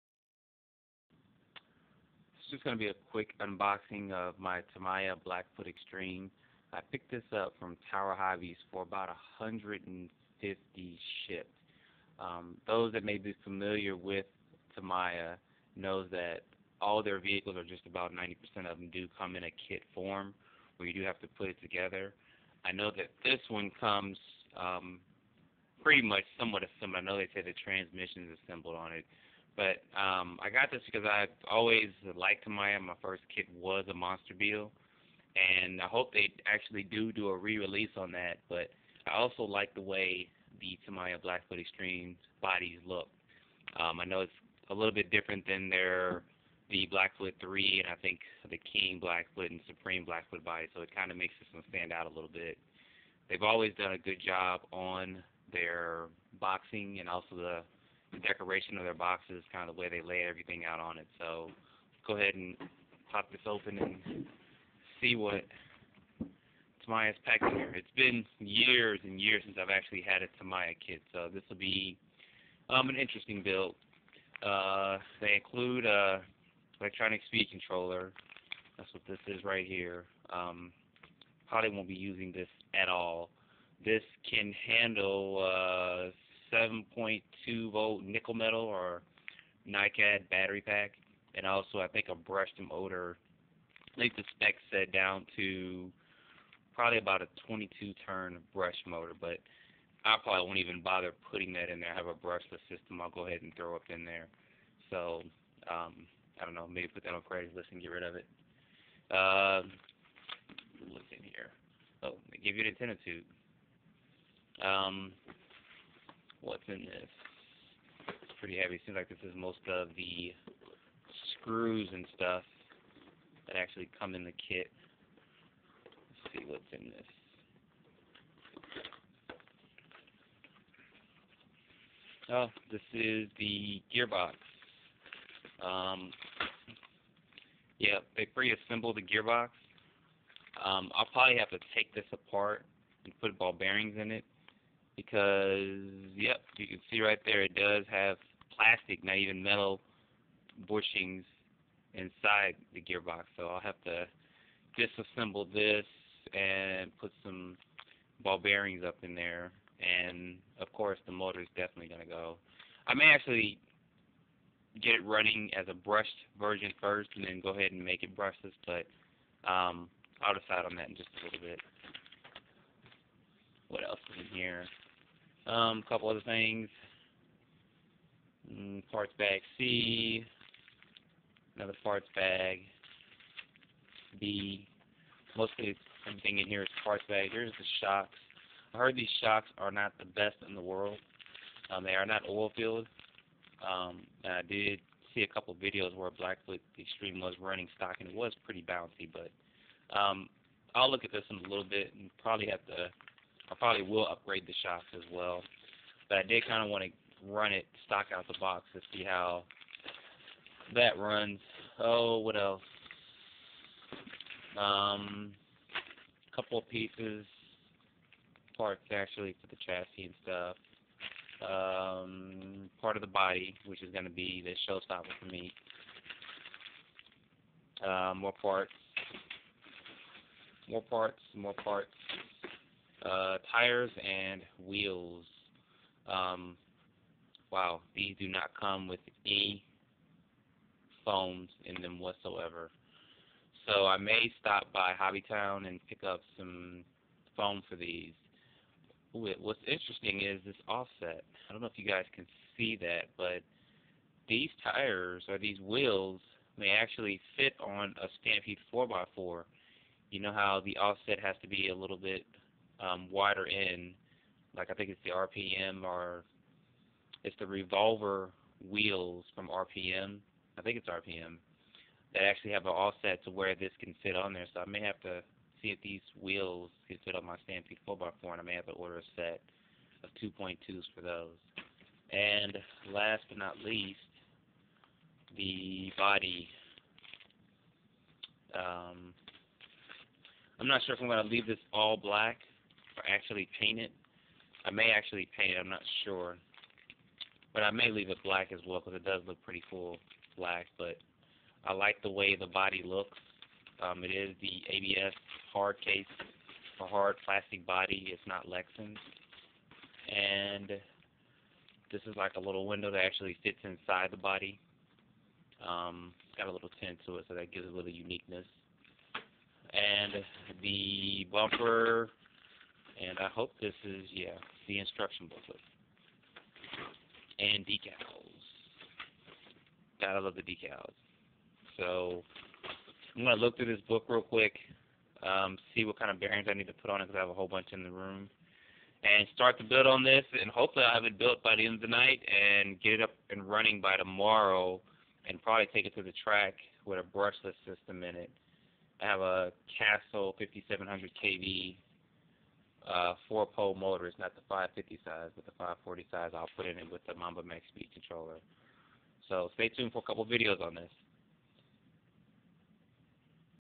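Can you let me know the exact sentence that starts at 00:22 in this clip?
I know that this one comes um, pretty much somewhat assembled.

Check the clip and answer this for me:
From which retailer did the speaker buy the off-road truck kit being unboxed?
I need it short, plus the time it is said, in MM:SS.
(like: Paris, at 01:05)
Tower Hobbies, at 00:07.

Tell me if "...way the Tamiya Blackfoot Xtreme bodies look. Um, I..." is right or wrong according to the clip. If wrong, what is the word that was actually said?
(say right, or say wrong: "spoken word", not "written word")
right.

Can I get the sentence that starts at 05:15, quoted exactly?
Um, it's got a little tint to it, so that gives it a little uniqueness.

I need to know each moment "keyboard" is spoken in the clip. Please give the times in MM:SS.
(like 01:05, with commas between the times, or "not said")
not said.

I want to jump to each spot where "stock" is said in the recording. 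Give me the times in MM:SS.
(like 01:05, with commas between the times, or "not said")
03:17, 03:27.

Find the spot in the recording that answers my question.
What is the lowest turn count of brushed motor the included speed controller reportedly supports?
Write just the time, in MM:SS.
01:37.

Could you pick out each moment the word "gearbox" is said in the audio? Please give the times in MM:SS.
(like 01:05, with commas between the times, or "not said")
02:13, 02:19, 02:32.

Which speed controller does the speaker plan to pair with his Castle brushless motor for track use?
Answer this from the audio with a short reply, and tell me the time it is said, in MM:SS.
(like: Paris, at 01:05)
Mamba Max, at 05:57.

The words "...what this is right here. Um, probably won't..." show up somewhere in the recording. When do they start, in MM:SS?
01:18.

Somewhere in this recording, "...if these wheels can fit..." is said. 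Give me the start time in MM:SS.
04:35.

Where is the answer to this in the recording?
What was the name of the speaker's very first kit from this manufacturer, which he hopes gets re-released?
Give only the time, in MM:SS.
00:33.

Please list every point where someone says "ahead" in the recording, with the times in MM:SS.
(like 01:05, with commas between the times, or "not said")
01:02, 01:43, 02:47.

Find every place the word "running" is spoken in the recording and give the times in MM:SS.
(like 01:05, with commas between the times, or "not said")
02:45, 03:17, 05:43.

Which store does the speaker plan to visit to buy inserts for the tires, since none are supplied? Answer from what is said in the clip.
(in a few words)
Hobby Town.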